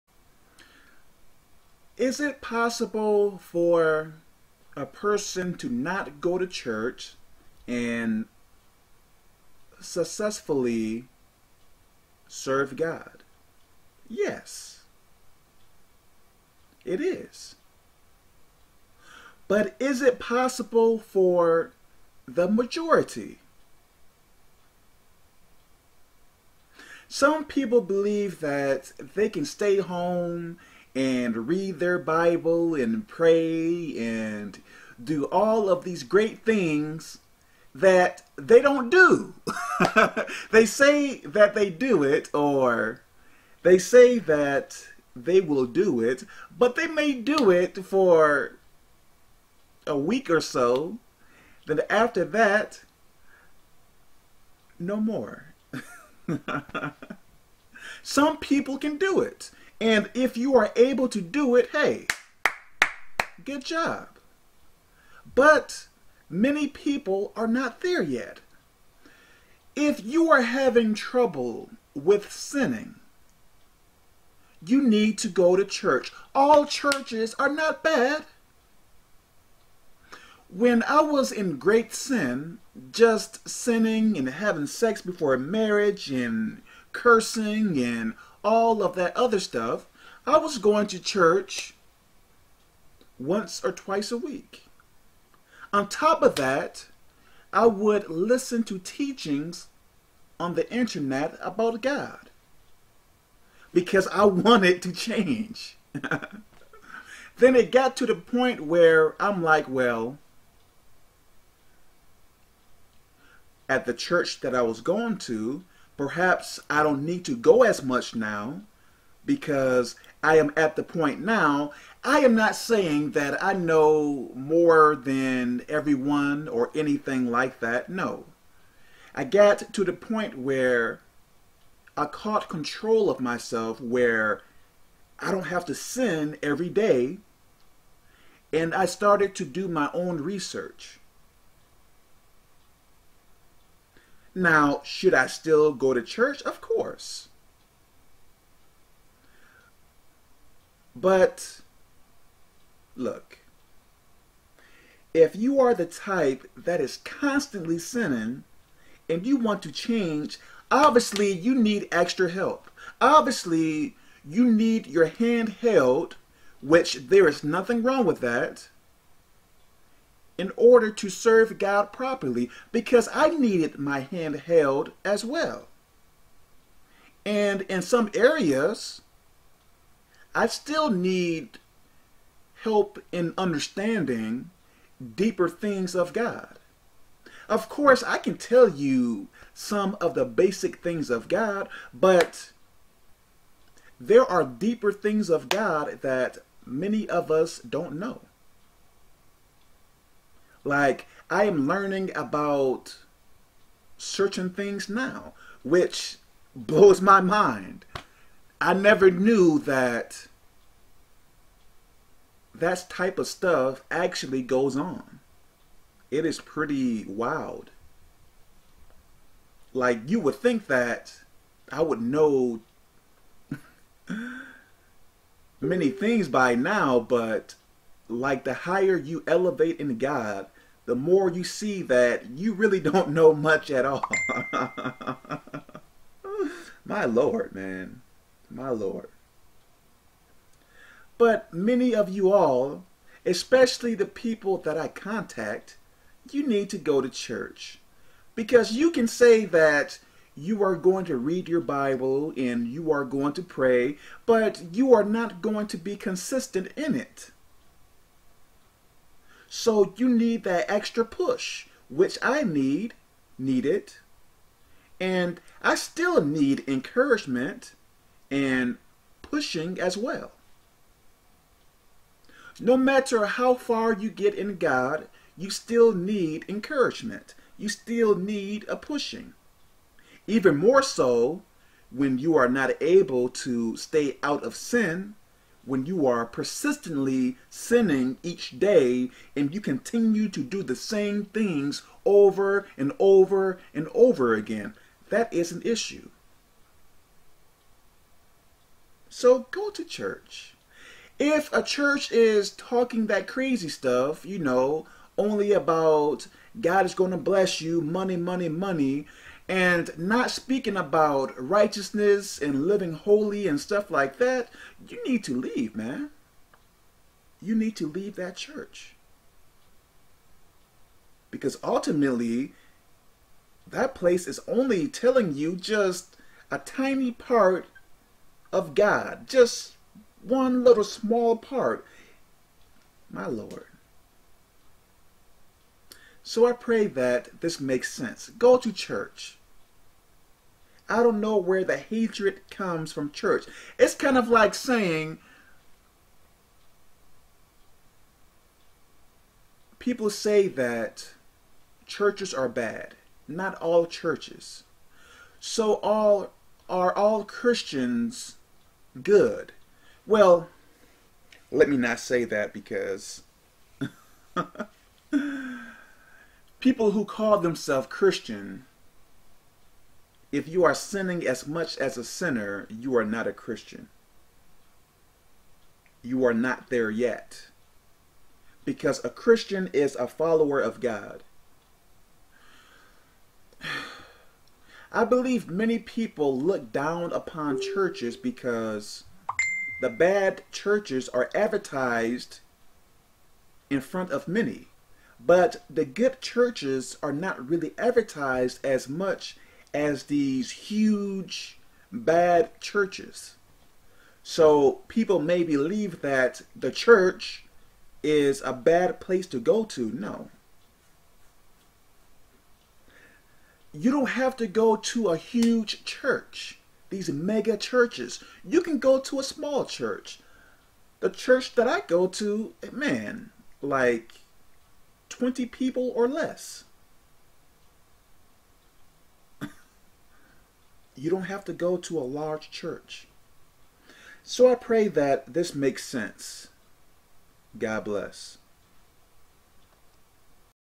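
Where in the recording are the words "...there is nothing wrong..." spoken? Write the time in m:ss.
2:47.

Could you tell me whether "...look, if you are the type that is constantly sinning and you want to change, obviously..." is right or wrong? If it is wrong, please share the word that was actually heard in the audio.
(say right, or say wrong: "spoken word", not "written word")
right.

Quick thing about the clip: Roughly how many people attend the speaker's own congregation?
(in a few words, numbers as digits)
20 or less.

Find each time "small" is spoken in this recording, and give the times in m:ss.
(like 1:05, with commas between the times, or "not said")
5:30, 6:59.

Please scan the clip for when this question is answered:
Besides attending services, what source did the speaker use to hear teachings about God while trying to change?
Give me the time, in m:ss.
1:40.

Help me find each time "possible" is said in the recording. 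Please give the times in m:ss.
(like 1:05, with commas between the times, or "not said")
0:02, 0:20.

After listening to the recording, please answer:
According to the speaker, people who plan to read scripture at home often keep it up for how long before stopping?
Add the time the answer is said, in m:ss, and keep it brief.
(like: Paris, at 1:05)
a week or so, at 0:49.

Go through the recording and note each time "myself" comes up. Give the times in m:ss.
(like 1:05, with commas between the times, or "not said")
2:13.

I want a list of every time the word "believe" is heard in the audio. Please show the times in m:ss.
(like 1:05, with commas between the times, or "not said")
0:27, 6:25, 6:45.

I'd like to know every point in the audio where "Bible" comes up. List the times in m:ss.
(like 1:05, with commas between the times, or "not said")
0:31, 4:11.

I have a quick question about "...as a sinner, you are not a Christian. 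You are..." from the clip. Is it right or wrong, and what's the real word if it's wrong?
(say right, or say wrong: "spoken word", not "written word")
right.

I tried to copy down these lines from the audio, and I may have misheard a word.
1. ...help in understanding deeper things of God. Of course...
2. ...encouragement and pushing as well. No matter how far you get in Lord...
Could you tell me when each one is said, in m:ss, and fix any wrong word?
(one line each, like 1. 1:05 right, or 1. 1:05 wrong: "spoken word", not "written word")
1. 3:02 right
2. 4:26 wrong: "God", not "Lord".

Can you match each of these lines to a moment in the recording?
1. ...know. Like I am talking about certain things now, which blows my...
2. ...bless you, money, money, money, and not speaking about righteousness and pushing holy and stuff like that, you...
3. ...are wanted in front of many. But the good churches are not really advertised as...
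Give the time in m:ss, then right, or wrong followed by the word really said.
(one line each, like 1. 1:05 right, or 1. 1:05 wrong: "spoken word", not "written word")
1. 3:17 wrong: "learning", not "talking"
2. 5:07 wrong: "living", not "pushing"
3. 6:31 wrong: "advertised", not "wanted".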